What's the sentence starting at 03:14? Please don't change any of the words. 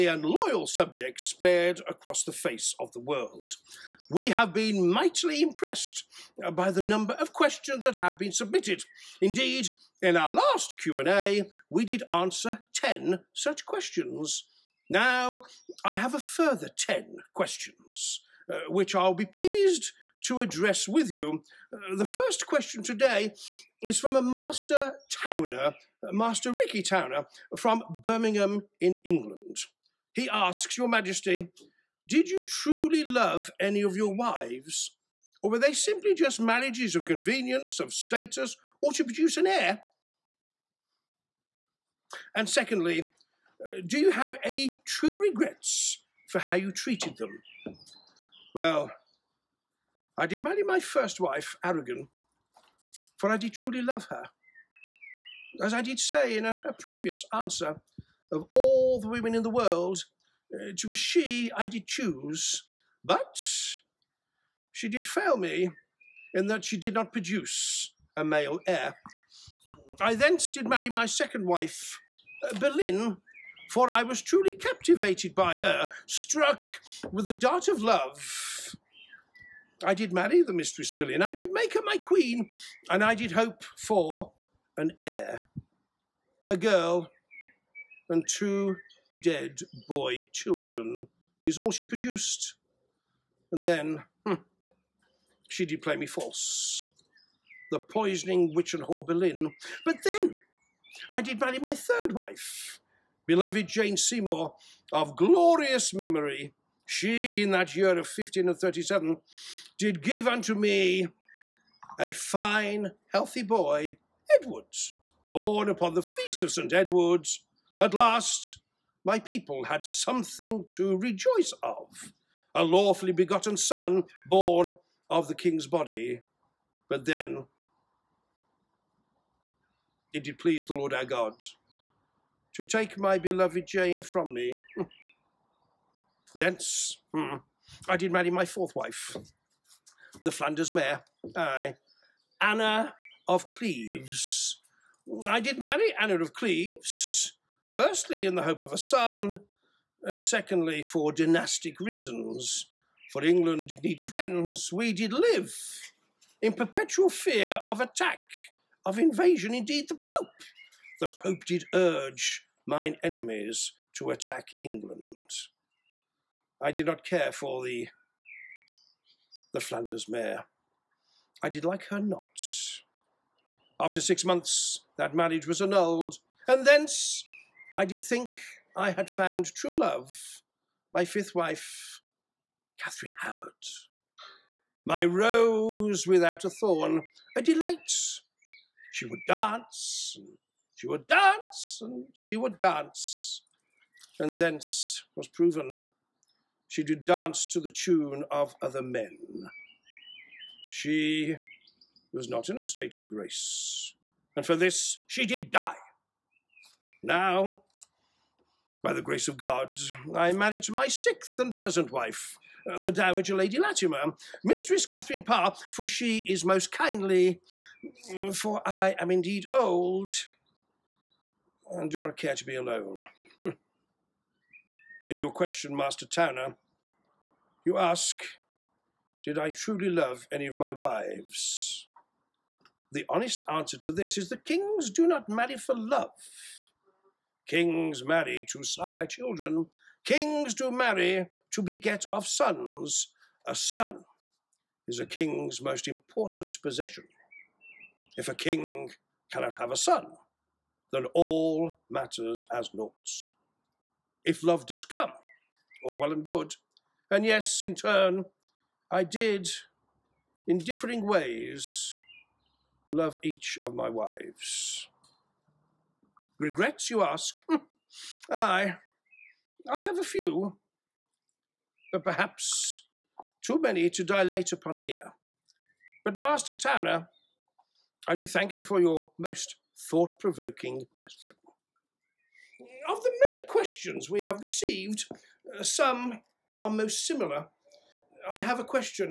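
And thence was proven she did dance to the tune of other men.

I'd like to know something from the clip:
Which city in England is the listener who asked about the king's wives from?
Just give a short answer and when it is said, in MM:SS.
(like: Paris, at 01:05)
Birmingham, at 00:28.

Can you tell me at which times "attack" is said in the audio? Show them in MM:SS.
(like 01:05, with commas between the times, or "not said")
02:37, 02:44.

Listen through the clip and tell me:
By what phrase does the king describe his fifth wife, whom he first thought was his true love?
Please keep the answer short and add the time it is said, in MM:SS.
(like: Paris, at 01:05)
My rose without a thorn, at 03:04.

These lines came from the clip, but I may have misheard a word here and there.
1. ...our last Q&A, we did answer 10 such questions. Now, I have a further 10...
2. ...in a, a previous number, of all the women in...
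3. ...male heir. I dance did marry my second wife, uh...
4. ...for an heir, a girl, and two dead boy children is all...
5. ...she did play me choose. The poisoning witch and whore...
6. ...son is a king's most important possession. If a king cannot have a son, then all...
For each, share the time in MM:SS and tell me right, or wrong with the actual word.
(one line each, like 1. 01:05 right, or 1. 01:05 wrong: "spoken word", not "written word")
1. 00:10 right
2. 00:56 wrong: "answer", not "number"
3. 01:08 wrong: "thence", not "dance"
4. 01:23 right
5. 01:35 wrong: "false", not "choose"
6. 04:03 right.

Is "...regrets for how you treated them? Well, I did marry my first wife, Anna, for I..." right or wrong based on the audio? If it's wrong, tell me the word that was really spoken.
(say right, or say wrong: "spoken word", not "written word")
wrong: "Aragon", not "Anna".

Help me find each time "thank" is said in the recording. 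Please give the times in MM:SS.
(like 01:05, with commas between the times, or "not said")
04:38.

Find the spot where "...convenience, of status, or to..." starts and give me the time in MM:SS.
00:37.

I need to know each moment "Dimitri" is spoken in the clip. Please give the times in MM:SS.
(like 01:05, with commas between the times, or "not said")
not said.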